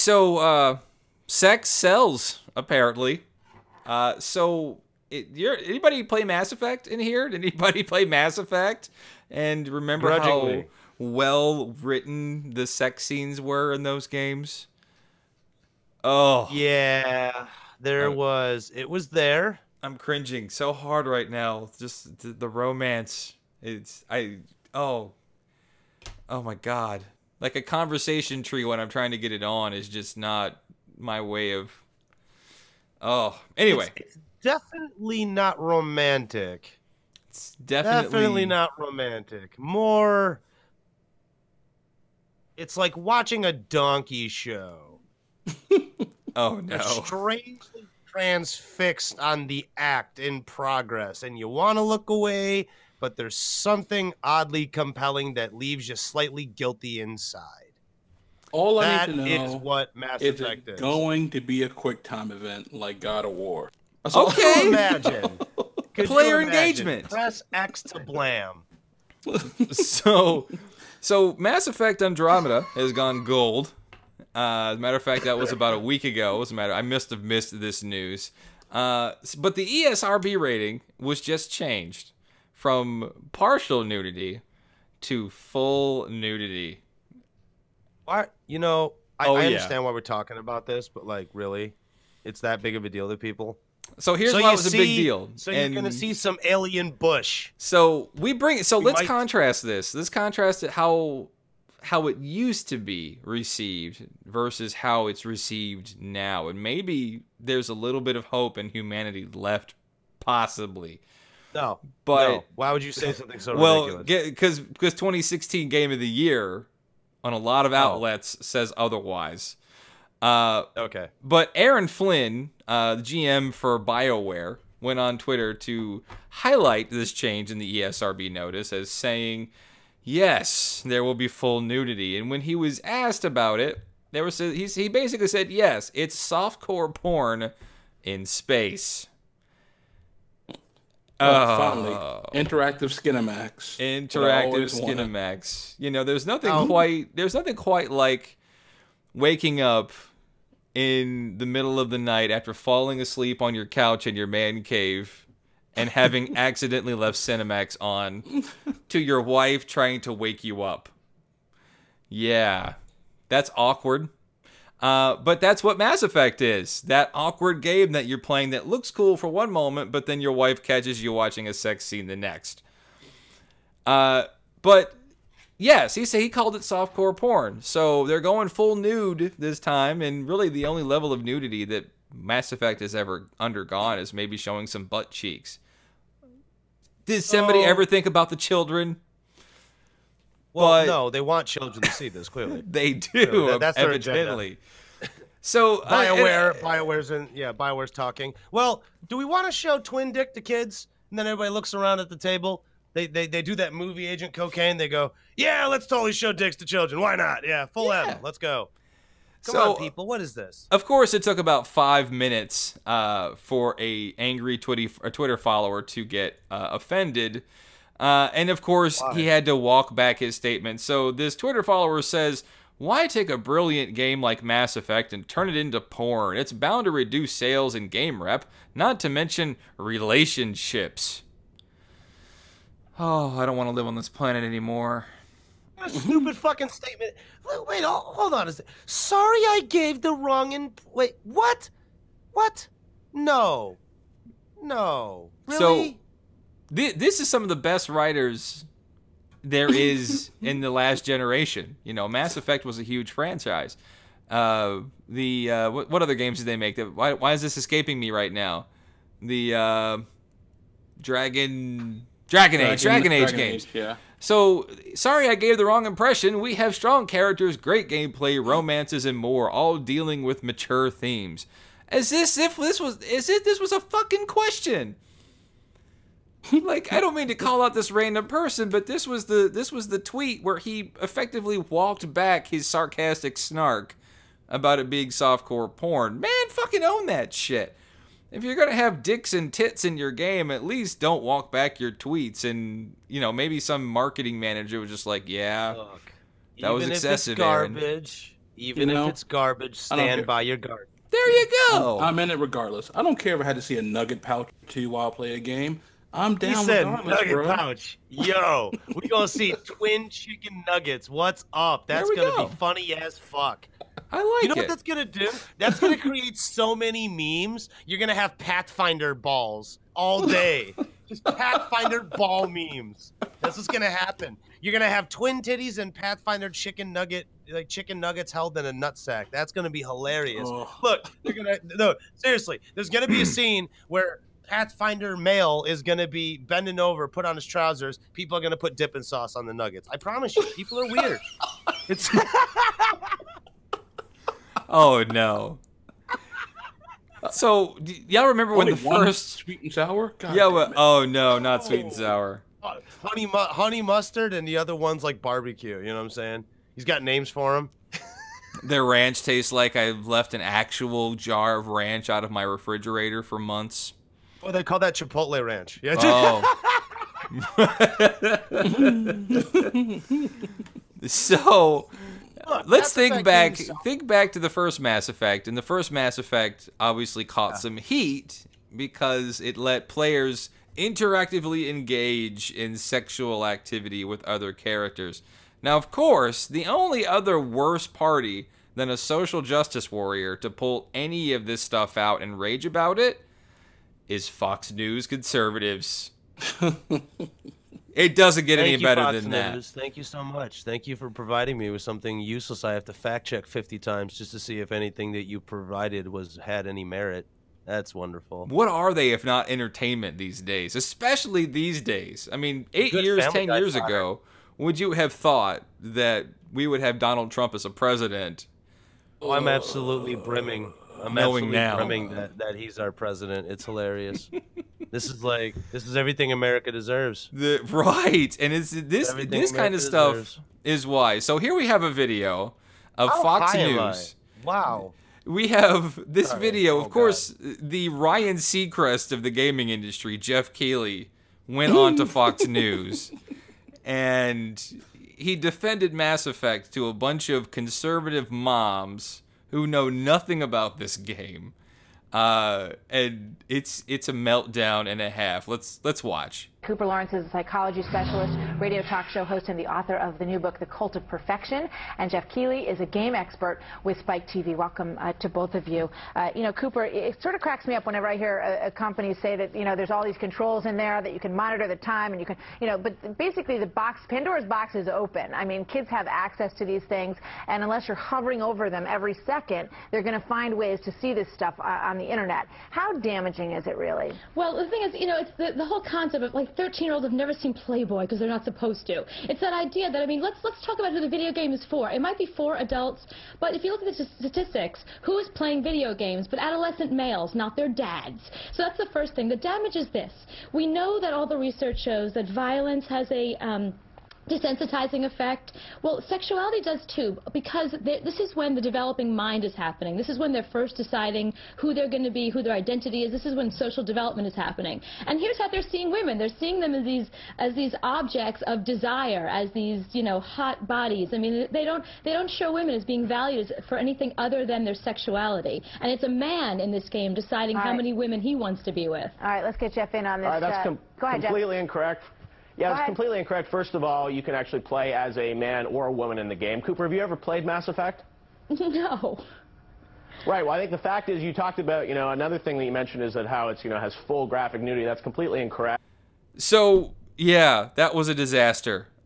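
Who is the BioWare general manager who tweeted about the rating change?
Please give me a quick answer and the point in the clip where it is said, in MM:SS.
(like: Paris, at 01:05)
Aaron Flynn, at 02:01.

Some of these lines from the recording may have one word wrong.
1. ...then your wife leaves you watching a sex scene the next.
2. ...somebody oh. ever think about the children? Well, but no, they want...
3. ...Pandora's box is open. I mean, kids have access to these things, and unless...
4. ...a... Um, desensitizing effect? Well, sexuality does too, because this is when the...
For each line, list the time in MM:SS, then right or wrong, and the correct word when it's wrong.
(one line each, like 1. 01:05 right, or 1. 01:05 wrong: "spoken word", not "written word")
1. 02:50 wrong: "catches", not "leaves"
2. 03:07 right
3. 07:54 right
4. 08:23 right.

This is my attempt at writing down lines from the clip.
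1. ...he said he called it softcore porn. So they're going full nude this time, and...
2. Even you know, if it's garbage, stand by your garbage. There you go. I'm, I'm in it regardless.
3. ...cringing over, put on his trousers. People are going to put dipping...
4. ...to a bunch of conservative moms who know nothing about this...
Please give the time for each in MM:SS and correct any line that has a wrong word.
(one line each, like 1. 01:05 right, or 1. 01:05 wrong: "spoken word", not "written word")
1. 02:55 right
2. 04:58 right
3. 05:36 wrong: "bending", not "cringing"
4. 07:26 right.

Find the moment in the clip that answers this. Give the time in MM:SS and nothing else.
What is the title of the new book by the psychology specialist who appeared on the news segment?
07:40.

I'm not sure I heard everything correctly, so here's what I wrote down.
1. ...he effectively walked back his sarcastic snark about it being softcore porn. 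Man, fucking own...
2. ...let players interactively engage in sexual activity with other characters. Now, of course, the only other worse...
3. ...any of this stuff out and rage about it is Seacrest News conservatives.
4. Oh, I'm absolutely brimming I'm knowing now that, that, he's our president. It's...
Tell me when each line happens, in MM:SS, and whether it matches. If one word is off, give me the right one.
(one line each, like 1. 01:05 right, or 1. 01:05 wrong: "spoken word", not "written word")
1. 04:40 right
2. 06:19 right
3. 06:30 wrong: "Fox", not "Seacrest"
4. 06:59 right.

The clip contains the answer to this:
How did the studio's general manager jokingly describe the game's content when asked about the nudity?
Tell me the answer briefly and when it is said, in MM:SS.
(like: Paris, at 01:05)
softcore porn in space, at 02:16.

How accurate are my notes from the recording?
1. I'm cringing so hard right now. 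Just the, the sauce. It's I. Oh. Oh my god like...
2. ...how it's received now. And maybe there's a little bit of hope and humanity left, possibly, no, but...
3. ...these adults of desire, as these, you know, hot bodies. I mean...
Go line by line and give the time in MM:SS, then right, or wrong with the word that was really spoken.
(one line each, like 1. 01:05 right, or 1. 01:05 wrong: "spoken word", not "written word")
1. 00:19 wrong: "romance", not "sauce"
2. 01:44 right
3. 08:37 wrong: "objects", not "adults".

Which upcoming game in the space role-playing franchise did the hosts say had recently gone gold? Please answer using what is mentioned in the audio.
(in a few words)
Mass Effect Andromeda.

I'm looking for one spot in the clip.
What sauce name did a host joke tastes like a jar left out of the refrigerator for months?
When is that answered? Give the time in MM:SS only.
06:04.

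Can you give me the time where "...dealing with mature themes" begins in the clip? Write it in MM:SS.
04:29.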